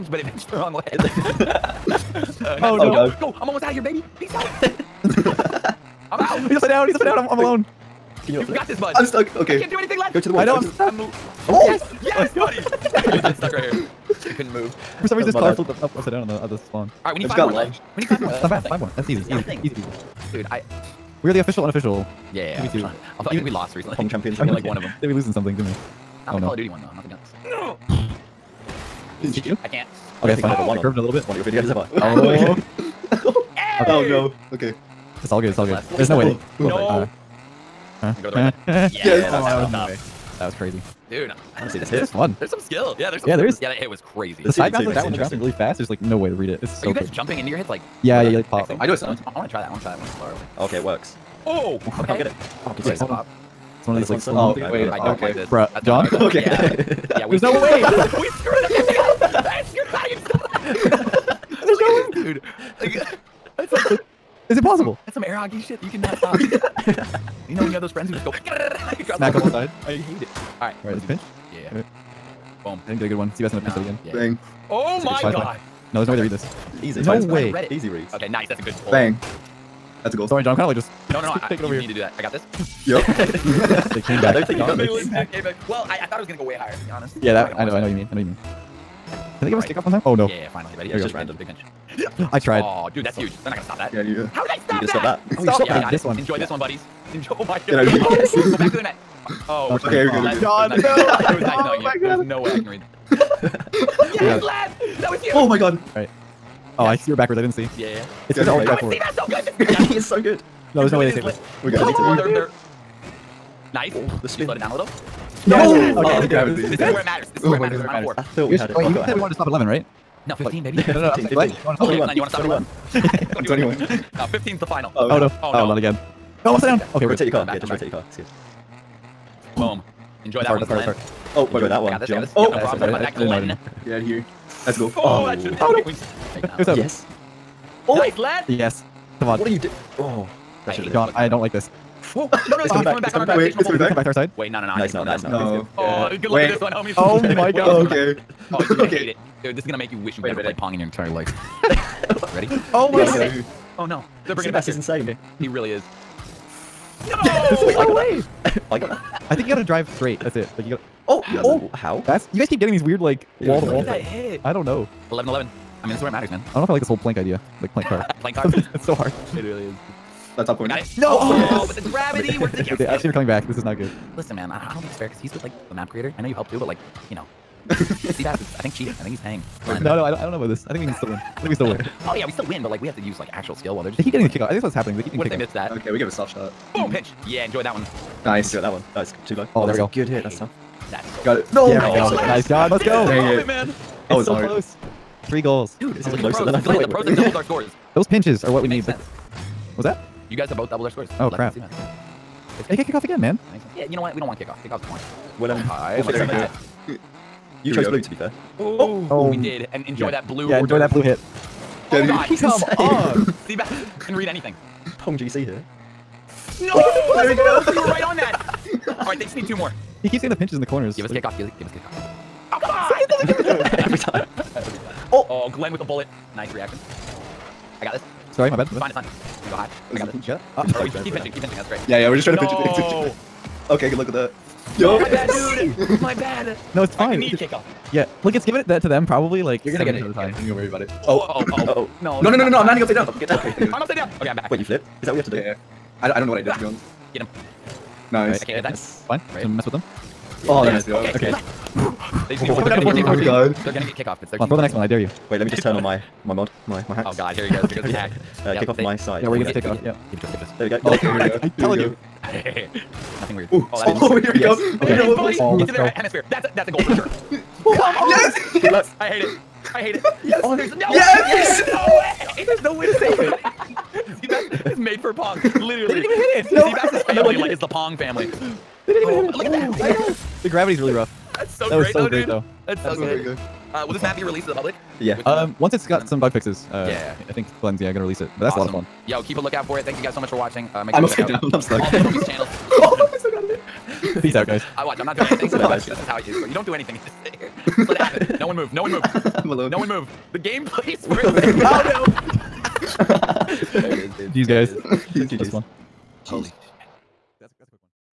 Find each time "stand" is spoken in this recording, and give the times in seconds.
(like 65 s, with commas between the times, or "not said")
not said.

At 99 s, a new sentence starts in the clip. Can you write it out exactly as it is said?
Oh, we're okay, okay we're good.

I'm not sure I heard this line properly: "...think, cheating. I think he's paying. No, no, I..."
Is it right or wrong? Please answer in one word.
right.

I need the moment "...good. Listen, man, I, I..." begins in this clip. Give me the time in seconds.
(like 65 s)
173 s.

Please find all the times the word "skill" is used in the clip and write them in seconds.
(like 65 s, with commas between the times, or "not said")
42 s, 183 s.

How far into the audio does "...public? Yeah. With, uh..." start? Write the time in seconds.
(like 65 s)
284 s.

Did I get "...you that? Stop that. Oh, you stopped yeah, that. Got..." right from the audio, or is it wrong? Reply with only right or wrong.
right.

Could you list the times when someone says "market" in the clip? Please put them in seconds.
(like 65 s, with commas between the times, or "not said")
not said.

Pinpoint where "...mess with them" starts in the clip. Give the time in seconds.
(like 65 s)
249 s.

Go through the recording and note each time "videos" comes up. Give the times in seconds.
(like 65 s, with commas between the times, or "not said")
31 s.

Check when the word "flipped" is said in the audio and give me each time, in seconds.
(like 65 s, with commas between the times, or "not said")
15 s, 244 s.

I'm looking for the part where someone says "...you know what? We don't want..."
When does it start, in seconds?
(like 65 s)
203 s.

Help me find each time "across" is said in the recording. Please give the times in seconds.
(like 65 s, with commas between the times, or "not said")
not said.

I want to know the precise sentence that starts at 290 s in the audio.
Uh, make sure I'm upside down.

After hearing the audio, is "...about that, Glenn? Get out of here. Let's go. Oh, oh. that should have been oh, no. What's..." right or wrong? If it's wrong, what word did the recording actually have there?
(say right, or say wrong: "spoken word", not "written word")
right.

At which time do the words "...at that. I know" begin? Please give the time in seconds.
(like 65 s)
279 s.